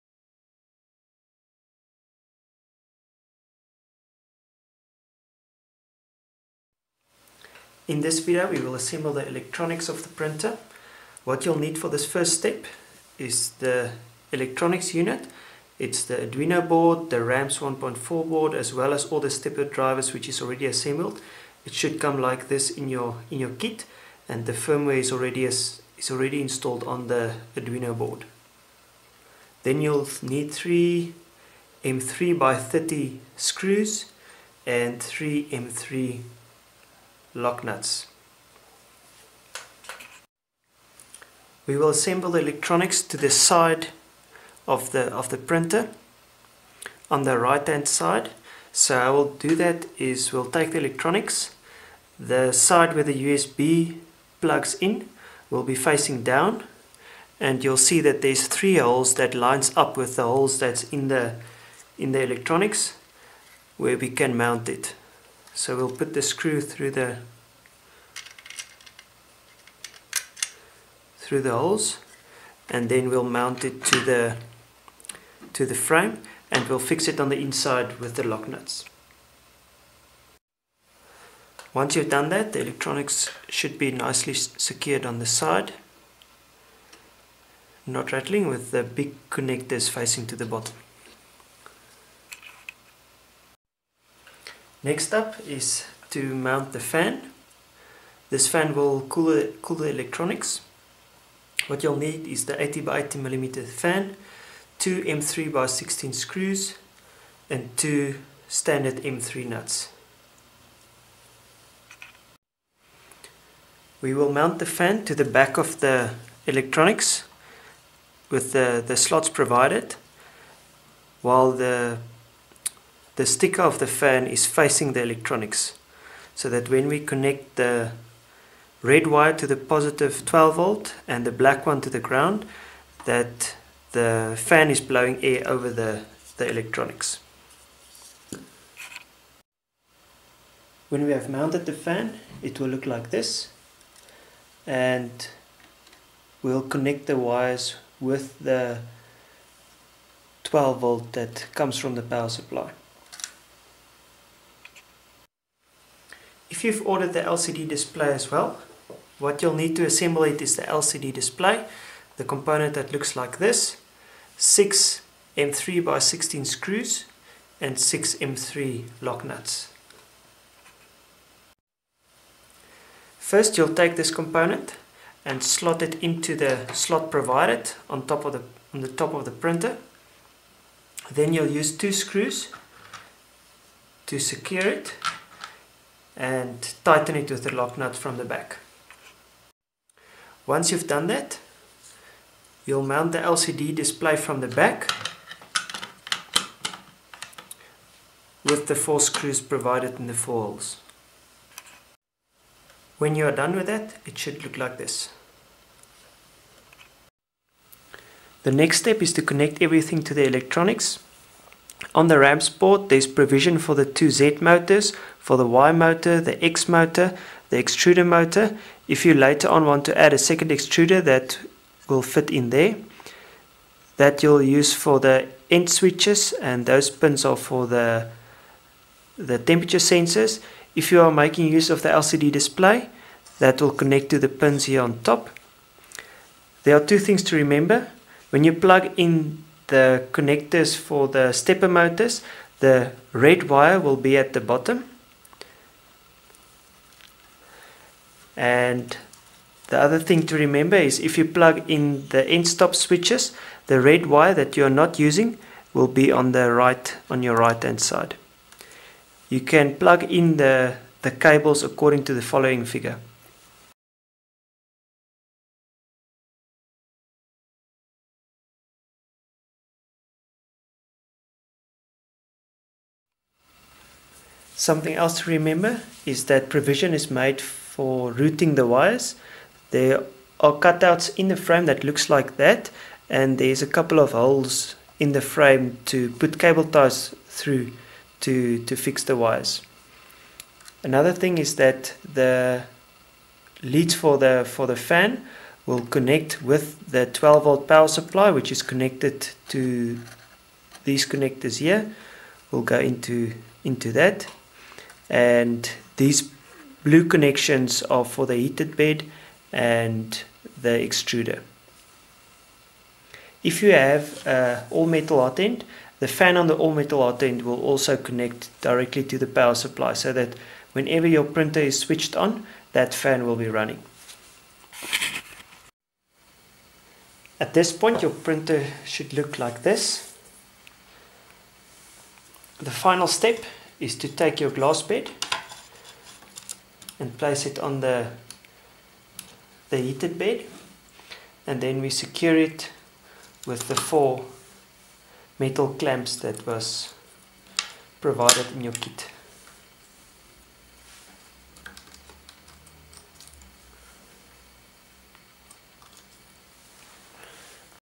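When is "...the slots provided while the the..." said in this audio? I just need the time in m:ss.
1:58.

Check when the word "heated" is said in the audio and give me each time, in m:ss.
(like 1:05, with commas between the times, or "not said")
5:08, 5:39.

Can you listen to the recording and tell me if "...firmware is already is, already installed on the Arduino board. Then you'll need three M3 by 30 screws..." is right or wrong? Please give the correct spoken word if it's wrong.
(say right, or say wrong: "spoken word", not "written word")
right.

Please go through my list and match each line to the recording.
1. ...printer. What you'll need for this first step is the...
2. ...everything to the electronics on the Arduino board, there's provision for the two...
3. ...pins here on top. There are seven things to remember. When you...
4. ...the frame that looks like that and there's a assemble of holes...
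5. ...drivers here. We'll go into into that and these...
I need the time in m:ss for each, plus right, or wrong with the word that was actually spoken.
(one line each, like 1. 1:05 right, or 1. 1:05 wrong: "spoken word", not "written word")
1. 0:10 right
2. 3:29 wrong: "RAMPS", not "Arduino"
3. 3:54 wrong: "two", not "seven"
4. 4:41 wrong: "couple", not "assemble"
5. 5:01 wrong: "connectors", not "drivers".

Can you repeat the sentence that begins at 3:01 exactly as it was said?
Then you'll use two screws to secure it and tighten it with the lock nut from the back.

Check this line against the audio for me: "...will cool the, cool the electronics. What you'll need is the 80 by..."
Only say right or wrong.
right.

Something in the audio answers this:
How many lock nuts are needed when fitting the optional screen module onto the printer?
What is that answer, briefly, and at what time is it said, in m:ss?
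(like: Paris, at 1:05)
6, at 2:47.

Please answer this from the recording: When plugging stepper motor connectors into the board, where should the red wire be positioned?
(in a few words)
At the bottom.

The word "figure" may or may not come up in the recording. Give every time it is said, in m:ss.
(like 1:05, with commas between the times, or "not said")
4:22.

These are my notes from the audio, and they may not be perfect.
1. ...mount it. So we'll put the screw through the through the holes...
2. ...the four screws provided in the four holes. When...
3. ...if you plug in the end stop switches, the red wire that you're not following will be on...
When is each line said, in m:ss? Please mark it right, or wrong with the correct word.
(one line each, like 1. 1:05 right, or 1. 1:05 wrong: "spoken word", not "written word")
1. 1:04 right
2. 3:18 right
3. 4:10 wrong: "using", not "following".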